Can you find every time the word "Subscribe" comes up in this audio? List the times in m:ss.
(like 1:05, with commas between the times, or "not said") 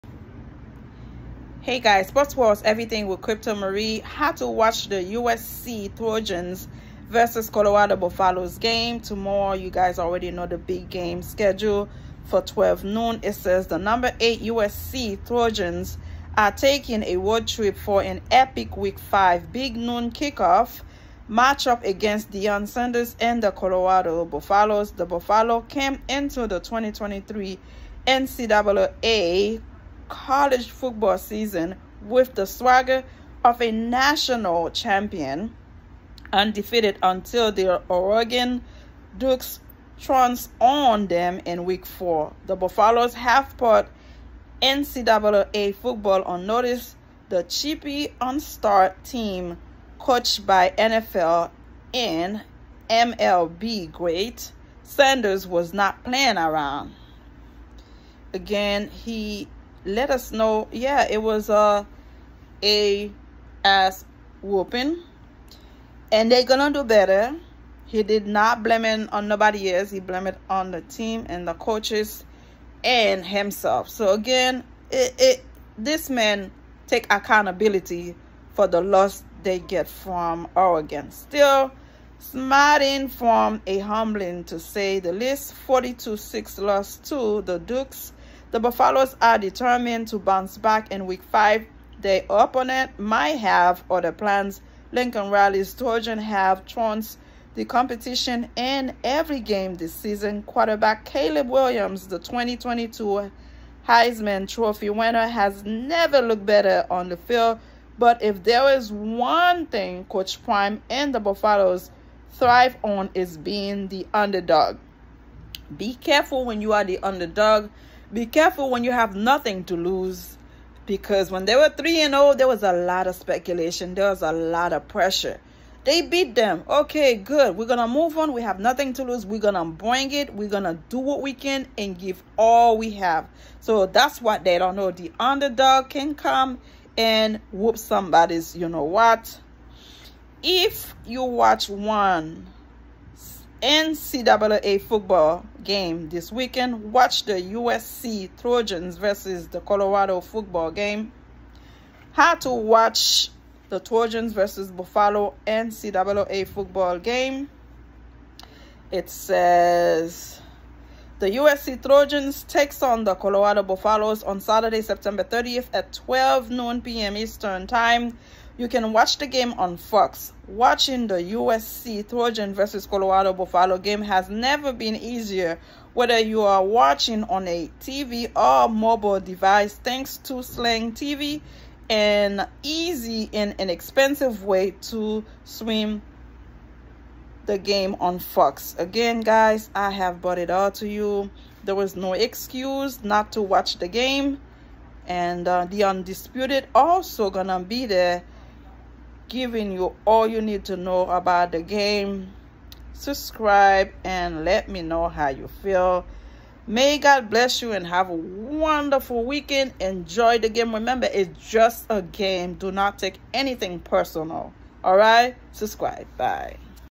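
3:22, 3:35.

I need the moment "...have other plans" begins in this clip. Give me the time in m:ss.
1:33.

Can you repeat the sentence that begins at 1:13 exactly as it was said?
So again, it, it this man take accountability for the loss they get from Oregon.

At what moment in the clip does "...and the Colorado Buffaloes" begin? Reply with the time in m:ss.
0:23.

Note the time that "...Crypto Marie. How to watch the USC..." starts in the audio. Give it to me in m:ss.
0:03.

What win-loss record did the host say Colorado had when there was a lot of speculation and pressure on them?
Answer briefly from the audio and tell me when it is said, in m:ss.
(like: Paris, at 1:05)
3 and 0, at 2:01.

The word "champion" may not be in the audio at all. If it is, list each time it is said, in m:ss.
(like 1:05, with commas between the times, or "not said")
0:34.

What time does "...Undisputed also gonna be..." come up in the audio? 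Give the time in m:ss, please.
3:15.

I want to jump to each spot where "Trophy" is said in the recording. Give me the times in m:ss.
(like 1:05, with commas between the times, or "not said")
1:44.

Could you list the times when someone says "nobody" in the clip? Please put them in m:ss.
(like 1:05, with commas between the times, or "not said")
1:09.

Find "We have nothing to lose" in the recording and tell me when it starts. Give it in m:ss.
2:08.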